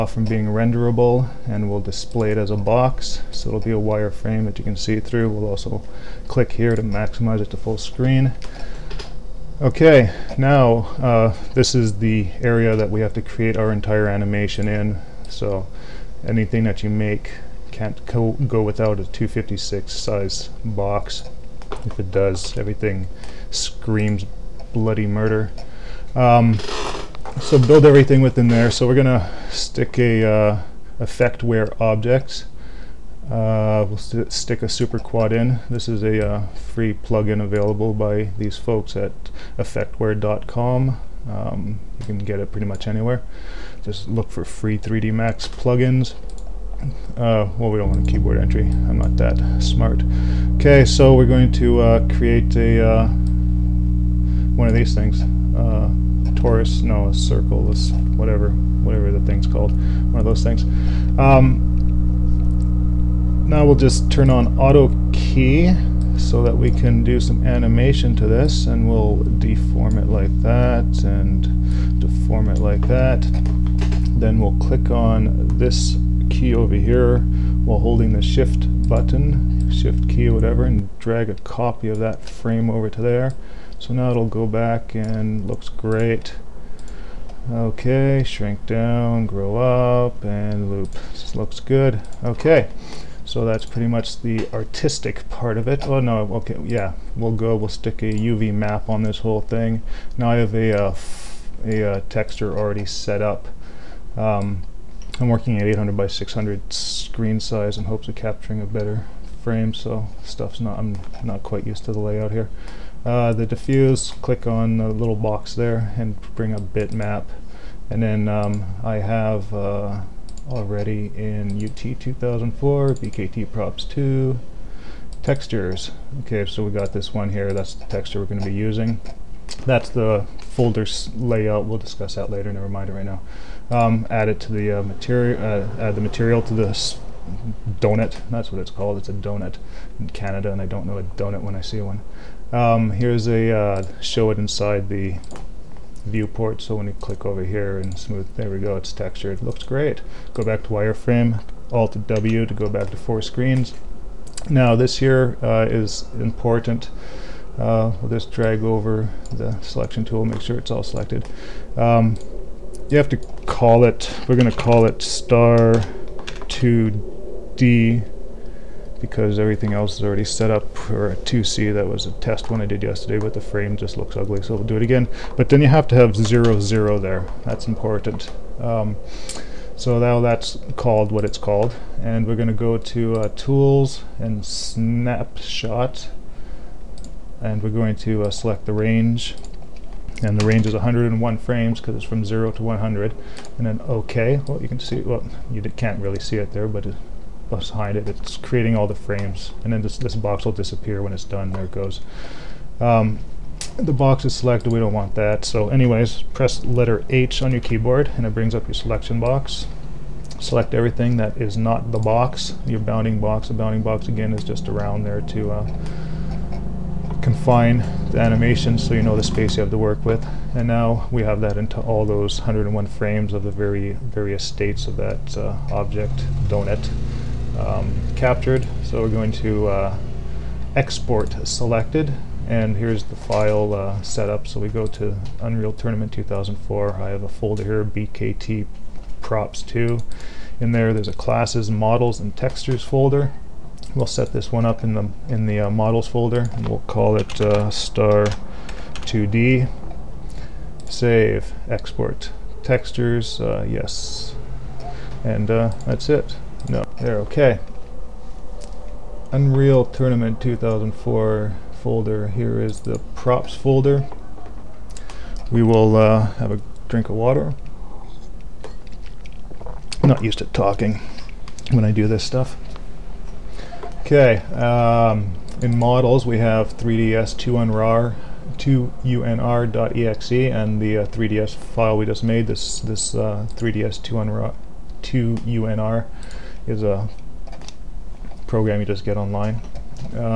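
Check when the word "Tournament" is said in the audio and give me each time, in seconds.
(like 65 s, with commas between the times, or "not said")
235 s, 259 s.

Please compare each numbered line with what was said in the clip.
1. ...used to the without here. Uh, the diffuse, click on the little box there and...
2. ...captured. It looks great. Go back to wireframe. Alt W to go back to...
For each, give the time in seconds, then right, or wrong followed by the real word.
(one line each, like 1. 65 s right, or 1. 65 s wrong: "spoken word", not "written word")
1. 111 s wrong: "layout", not "without"
2. 148 s wrong: "textured", not "captured".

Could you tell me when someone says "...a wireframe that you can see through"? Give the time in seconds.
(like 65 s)
3 s.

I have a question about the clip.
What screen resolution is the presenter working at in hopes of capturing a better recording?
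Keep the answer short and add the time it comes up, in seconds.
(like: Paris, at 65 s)
800 by 600, at 105 s.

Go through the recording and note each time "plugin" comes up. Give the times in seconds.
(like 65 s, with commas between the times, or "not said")
36 s, 45 s.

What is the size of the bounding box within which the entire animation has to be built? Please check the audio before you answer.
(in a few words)
256.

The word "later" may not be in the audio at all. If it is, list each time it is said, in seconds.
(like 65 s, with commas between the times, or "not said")
132 s.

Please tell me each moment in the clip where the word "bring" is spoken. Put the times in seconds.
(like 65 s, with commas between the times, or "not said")
116 s, 208 s.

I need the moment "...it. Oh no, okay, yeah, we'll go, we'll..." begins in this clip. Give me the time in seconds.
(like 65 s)
95 s.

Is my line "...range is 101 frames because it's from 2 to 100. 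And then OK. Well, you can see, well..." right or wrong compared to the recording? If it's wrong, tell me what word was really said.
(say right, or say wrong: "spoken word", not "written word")
wrong: "0", not "2".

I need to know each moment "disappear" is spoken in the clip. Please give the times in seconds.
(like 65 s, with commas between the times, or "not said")
200 s.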